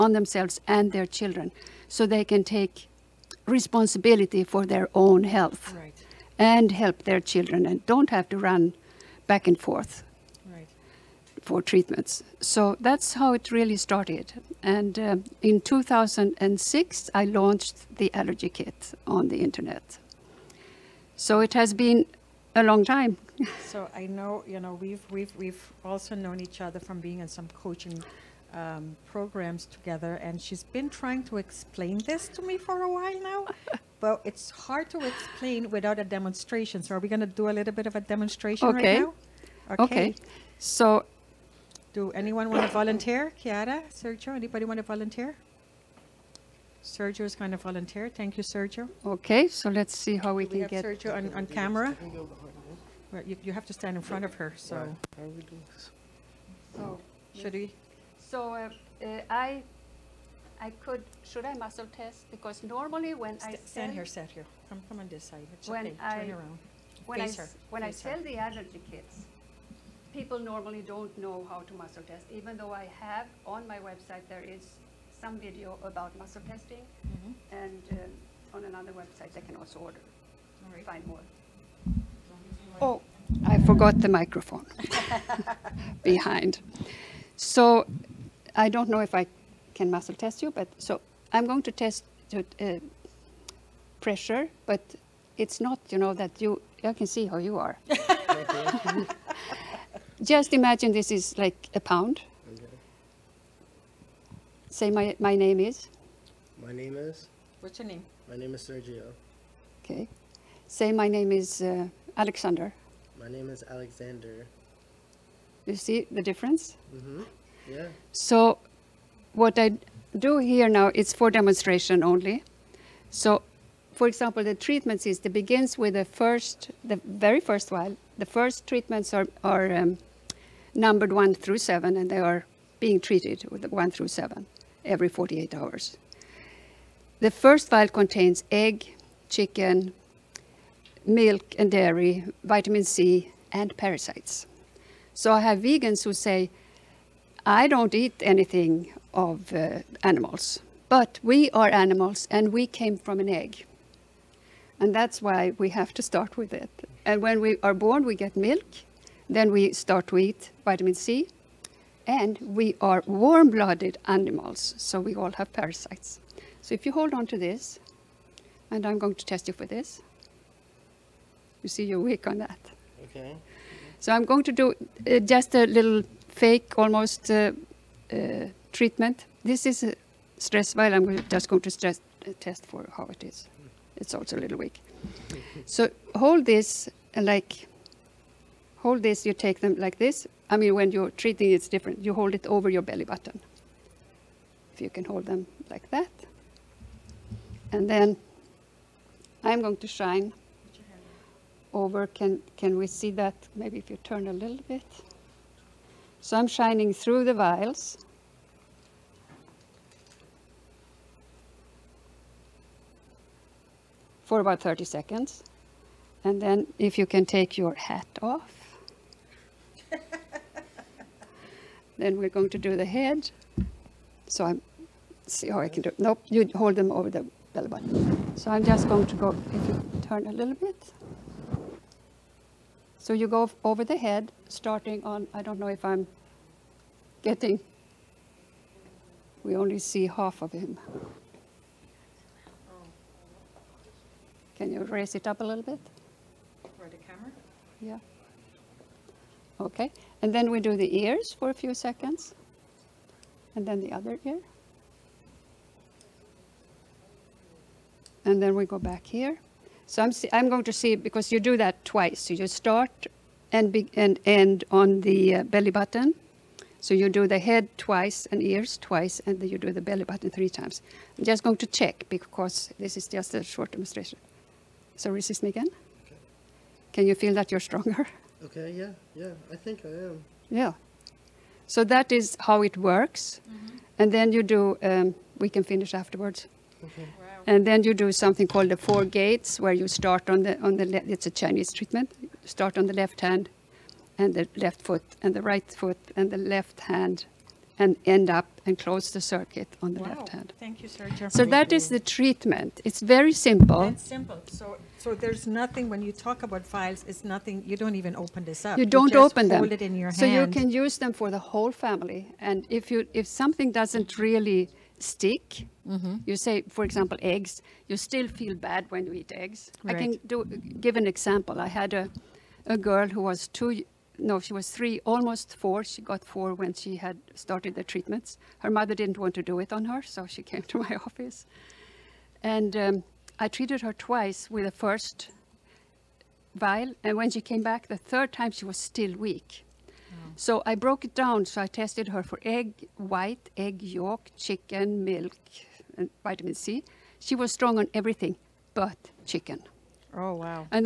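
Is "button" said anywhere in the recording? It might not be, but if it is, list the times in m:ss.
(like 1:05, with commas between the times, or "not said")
3:13, 3:47, 4:25, 4:30.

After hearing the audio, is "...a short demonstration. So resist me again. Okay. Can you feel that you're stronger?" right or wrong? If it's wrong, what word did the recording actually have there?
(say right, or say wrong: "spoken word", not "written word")
right.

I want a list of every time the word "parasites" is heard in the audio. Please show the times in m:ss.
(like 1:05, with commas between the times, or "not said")
2:23, 2:45.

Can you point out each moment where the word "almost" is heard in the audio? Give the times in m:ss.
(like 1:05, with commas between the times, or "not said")
2:56, 5:25.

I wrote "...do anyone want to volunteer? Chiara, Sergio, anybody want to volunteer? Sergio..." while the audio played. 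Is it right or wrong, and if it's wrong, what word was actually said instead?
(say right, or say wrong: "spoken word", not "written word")
right.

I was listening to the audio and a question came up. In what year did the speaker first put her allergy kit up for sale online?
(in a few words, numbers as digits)
2006.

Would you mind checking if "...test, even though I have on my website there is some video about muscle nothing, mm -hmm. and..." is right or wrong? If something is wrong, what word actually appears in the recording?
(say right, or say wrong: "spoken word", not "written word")
wrong: "testing", not "nothing".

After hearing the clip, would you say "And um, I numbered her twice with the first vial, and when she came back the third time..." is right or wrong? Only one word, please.
wrong.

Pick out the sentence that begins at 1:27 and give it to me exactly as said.
So I don't know if I can muscle test you.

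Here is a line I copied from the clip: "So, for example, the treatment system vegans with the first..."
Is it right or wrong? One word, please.
wrong.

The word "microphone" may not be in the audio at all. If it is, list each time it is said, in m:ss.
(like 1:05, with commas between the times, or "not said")
1:24.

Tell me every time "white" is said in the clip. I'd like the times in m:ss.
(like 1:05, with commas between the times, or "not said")
5:42.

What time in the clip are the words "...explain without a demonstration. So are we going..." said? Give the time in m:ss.
0:35.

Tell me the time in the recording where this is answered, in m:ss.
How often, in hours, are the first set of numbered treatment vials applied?
2:15.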